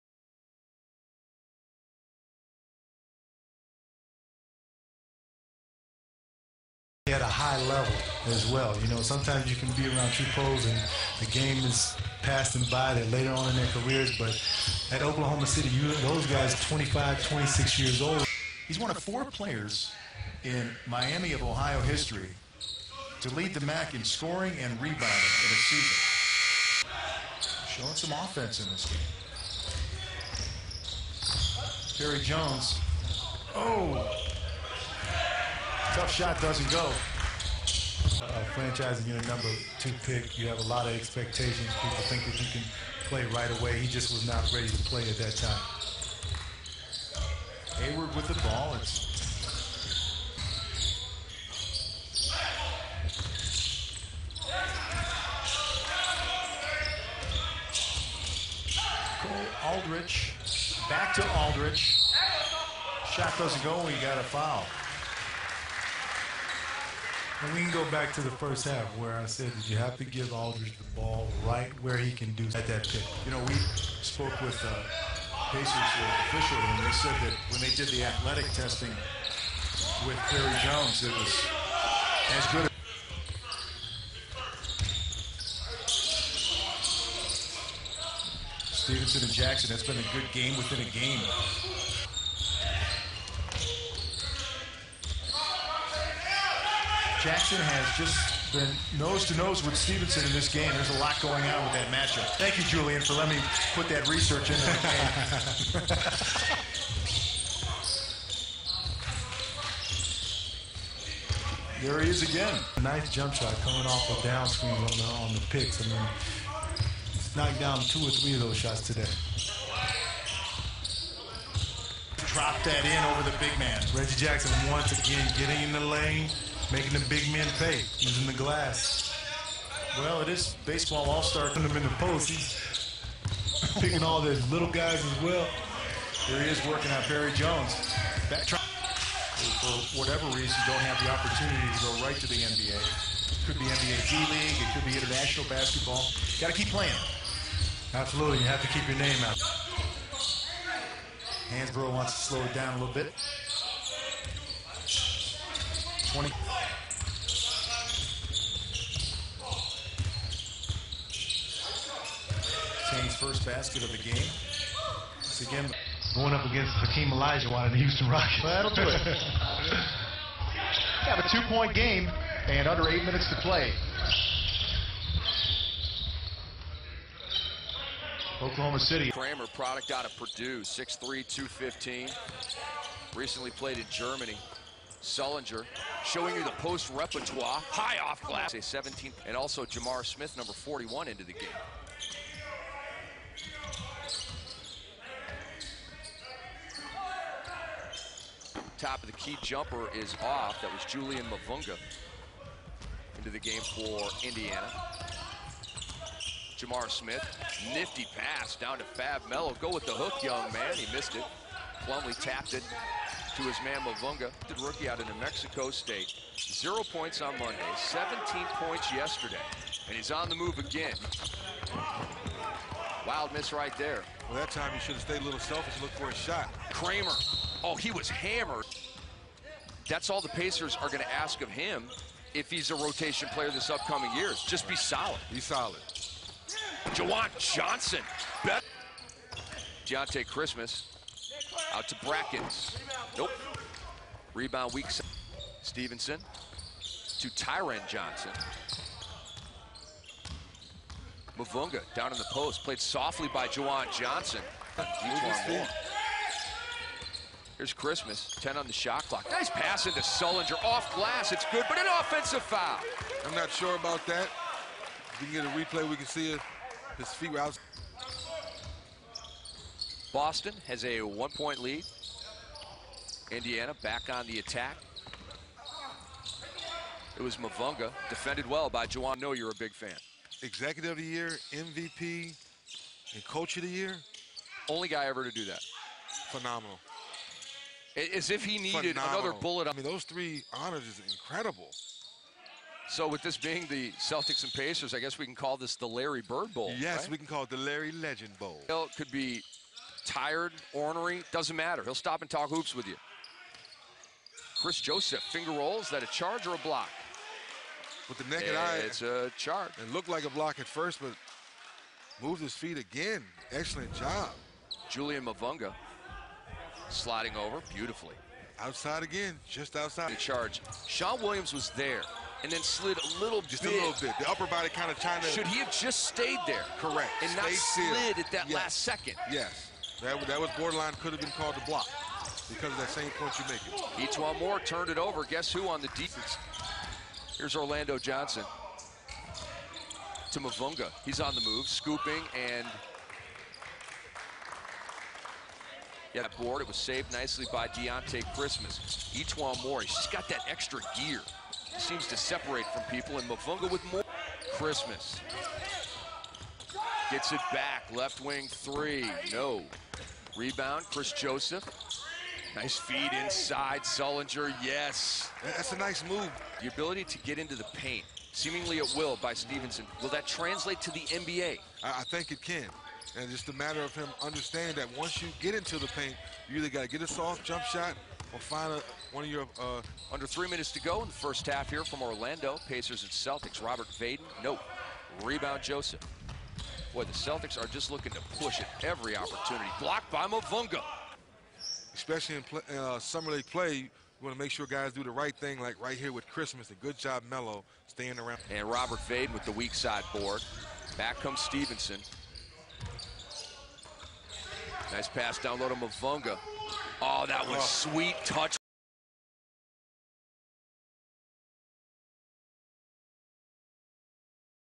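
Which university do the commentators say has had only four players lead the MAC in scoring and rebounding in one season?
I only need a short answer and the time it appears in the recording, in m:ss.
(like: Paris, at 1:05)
Miami of Ohio, at 0:20.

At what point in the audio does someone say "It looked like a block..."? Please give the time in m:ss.
5:09.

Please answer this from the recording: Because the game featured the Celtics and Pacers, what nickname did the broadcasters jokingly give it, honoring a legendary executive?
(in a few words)
Larry Bird Bowl.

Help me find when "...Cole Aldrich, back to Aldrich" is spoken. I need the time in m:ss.
0:59.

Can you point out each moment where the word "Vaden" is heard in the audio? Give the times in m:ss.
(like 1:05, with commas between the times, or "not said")
6:23, 6:39.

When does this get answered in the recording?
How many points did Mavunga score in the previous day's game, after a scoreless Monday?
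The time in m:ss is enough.
3:37.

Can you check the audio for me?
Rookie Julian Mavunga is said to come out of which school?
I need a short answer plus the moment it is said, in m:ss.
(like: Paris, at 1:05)
New Mexico State, at 3:35.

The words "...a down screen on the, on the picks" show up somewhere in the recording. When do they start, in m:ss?
1:54.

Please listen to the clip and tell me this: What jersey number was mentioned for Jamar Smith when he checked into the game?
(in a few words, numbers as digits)
41.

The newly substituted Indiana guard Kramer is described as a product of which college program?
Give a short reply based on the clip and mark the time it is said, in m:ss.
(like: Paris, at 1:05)
Purdue, at 3:00.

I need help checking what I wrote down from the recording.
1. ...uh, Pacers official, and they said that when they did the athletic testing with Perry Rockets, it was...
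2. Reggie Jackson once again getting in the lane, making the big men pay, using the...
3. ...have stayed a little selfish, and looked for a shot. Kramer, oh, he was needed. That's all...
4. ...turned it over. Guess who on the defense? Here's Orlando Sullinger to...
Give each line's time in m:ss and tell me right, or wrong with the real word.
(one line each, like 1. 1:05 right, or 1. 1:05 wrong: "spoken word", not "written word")
1. 1:14 wrong: "Jones", not "Rockets"
2. 2:03 right
3. 3:44 wrong: "hammered", not "needed"
4. 5:34 wrong: "Johnson", not "Sullinger".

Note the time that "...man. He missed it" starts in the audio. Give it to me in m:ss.
3:30.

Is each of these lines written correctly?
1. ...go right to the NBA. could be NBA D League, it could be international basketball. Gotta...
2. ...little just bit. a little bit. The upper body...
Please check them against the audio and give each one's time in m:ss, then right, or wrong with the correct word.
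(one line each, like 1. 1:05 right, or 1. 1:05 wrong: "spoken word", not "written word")
1. 2:21 right
2. 5:23 right.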